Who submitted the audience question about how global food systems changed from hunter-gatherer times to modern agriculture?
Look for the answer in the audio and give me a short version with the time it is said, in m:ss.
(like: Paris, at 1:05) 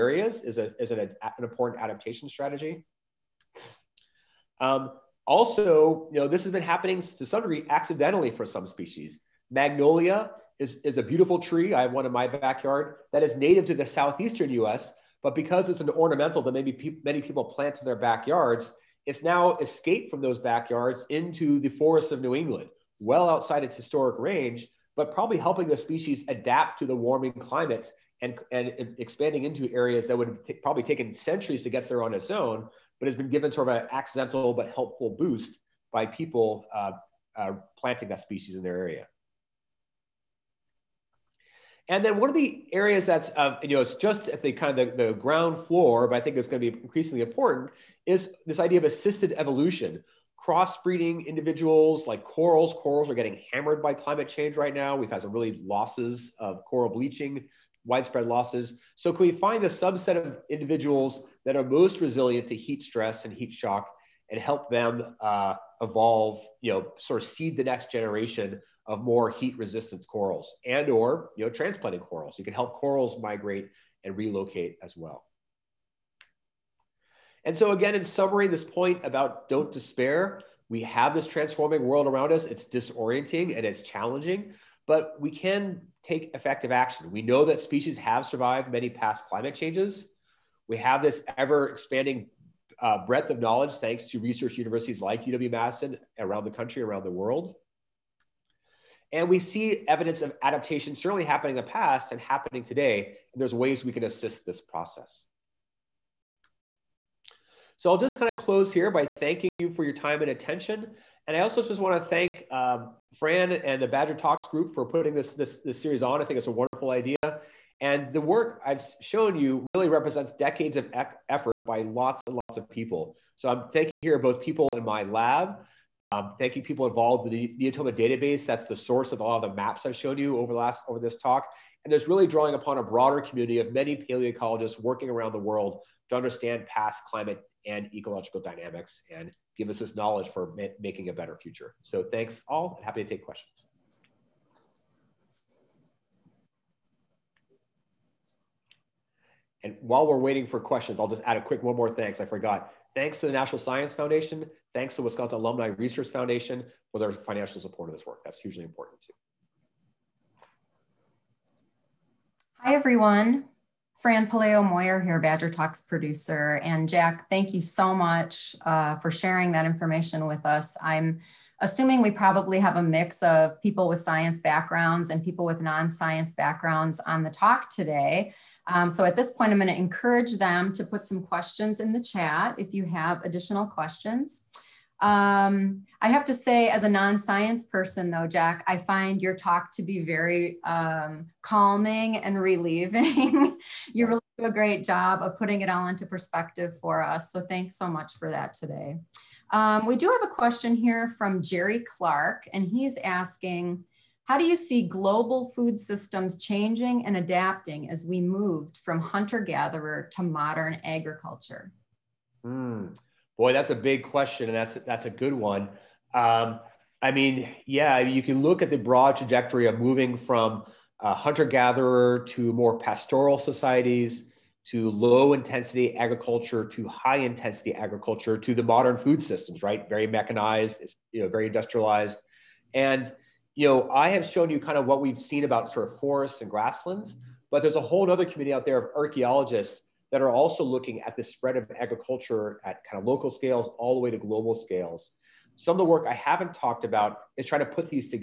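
Jerry Clark, at 3:21.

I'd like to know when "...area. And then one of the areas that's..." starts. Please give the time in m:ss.
0:38.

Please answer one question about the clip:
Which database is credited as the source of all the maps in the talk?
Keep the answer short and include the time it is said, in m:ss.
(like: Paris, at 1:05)
Neotoma, at 2:07.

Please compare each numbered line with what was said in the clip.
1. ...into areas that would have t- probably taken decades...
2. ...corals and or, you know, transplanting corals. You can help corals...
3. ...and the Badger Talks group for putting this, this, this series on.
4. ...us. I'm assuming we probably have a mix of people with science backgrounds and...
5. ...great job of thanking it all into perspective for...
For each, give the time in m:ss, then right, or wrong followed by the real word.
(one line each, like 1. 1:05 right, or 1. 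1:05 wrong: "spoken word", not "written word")
1. 0:29 wrong: "centuries", not "decades"
2. 1:10 right
3. 1:53 right
4. 2:50 right
5. 3:14 wrong: "putting", not "thanking".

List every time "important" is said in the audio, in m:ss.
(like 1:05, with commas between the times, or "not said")
0:01, 0:47, 2:38.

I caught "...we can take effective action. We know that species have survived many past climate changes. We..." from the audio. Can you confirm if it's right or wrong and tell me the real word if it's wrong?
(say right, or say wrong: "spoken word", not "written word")
right.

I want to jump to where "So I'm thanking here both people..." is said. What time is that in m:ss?
2:03.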